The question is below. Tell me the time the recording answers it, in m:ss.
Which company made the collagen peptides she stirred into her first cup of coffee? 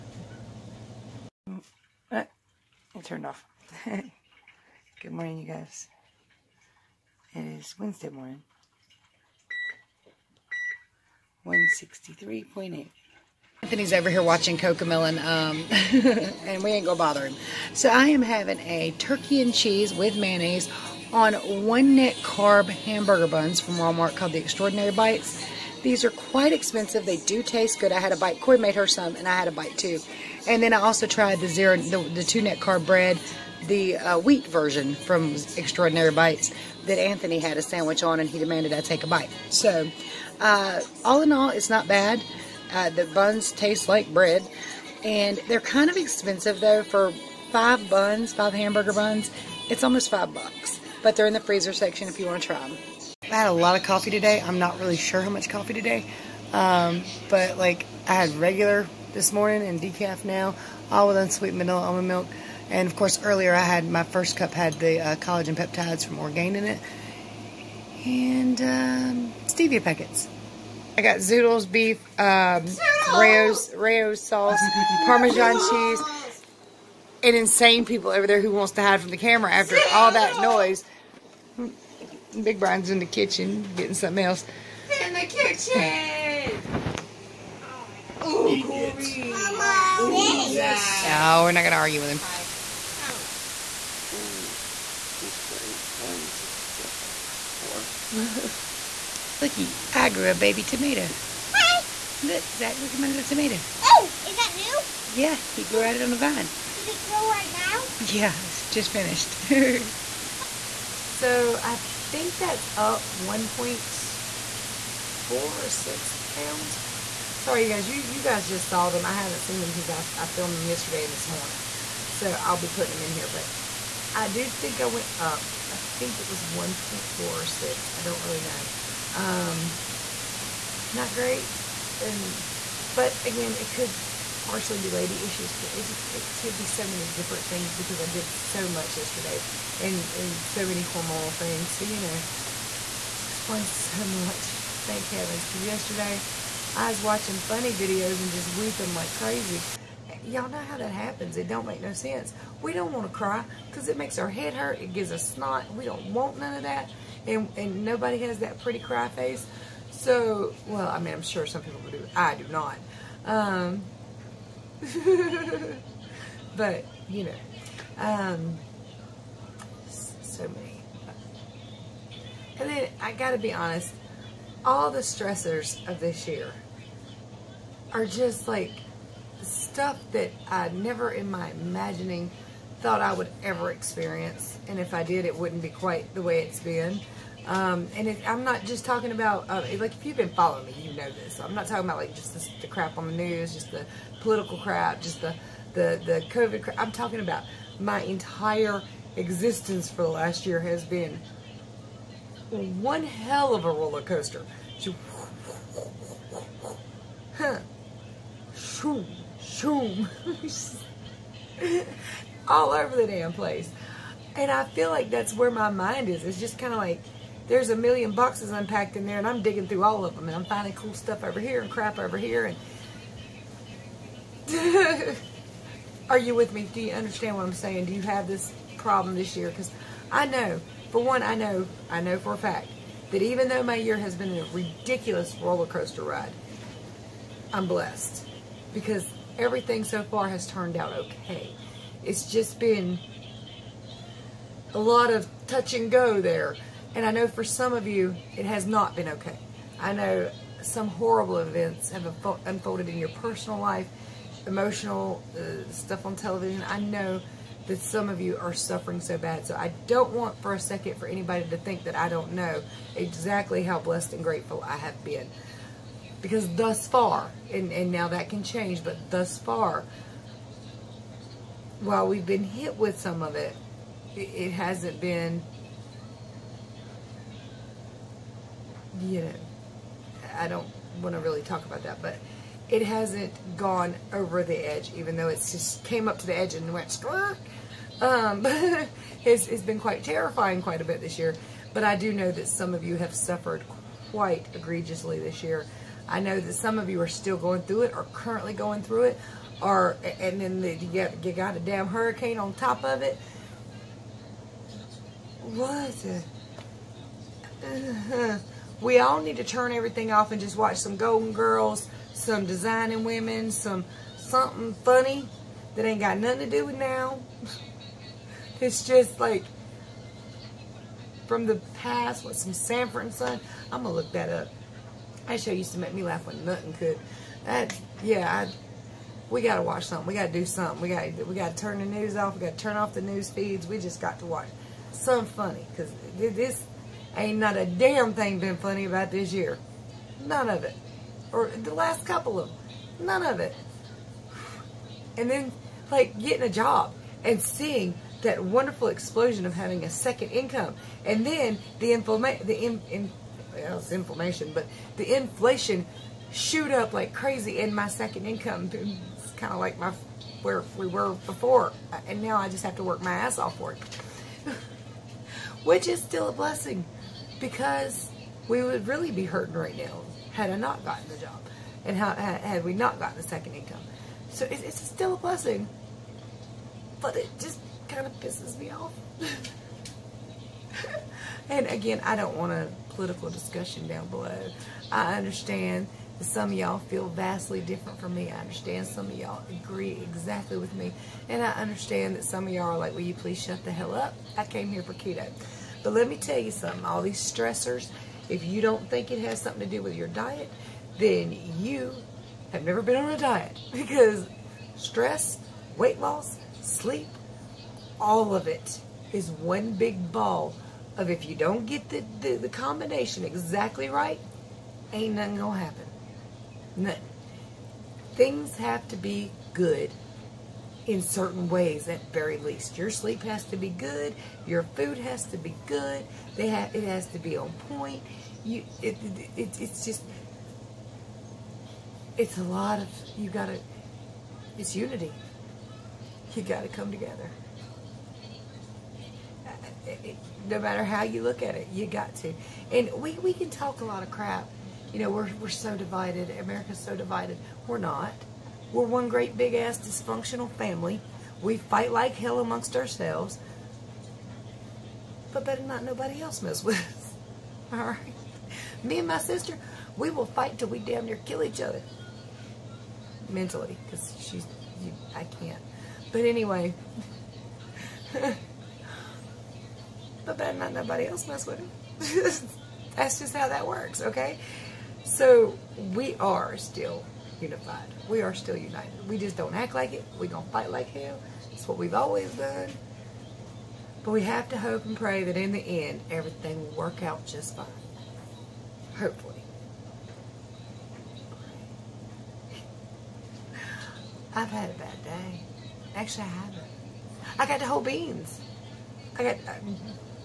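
1:06.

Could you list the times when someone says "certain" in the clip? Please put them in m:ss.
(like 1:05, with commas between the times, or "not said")
7:01.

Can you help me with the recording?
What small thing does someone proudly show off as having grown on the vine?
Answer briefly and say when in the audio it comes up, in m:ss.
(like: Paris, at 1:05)
a baby tomato, at 1:40.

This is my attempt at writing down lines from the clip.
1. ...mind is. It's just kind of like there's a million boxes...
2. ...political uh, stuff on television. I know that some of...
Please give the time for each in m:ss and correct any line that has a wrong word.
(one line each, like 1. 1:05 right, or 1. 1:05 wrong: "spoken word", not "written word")
1. 3:35 right
2. 4:14 wrong: "emotional", not "political".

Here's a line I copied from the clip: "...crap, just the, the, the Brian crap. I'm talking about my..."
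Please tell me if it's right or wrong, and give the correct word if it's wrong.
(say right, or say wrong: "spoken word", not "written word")
wrong: "COVID", not "Brian".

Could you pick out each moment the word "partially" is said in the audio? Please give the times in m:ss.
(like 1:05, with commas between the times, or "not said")
2:14.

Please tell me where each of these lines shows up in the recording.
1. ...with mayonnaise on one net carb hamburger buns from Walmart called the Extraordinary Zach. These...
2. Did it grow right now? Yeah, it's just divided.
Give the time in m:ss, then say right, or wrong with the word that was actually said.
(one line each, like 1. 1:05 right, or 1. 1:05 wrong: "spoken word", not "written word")
1. 0:19 wrong: "Bites", not "Zach"
2. 1:46 wrong: "finished", not "divided".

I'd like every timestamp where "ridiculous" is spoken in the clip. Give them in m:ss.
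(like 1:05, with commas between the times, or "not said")
3:54.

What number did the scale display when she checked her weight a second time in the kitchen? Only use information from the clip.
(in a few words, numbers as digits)
164.4.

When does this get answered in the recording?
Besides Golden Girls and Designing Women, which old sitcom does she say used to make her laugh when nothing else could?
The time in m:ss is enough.
5:22.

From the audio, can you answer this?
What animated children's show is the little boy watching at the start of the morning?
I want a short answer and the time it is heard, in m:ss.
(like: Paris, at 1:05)
Cocomelon, at 0:14.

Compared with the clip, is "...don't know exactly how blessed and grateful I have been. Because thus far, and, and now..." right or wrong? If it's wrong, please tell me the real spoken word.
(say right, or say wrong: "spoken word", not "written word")
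right.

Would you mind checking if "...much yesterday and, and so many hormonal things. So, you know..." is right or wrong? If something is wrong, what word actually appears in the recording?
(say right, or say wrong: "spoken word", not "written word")
right.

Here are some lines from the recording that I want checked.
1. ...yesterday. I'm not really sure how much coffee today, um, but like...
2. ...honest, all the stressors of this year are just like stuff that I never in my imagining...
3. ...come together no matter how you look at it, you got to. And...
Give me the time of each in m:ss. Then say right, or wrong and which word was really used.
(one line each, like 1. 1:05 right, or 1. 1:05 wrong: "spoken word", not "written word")
1. 0:54 wrong: "today", not "yesterday"
2. 2:53 right
3. 7:16 right.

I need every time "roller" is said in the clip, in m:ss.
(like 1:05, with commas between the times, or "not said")
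3:23, 3:55.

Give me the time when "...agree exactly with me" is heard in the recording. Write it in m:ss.
6:29.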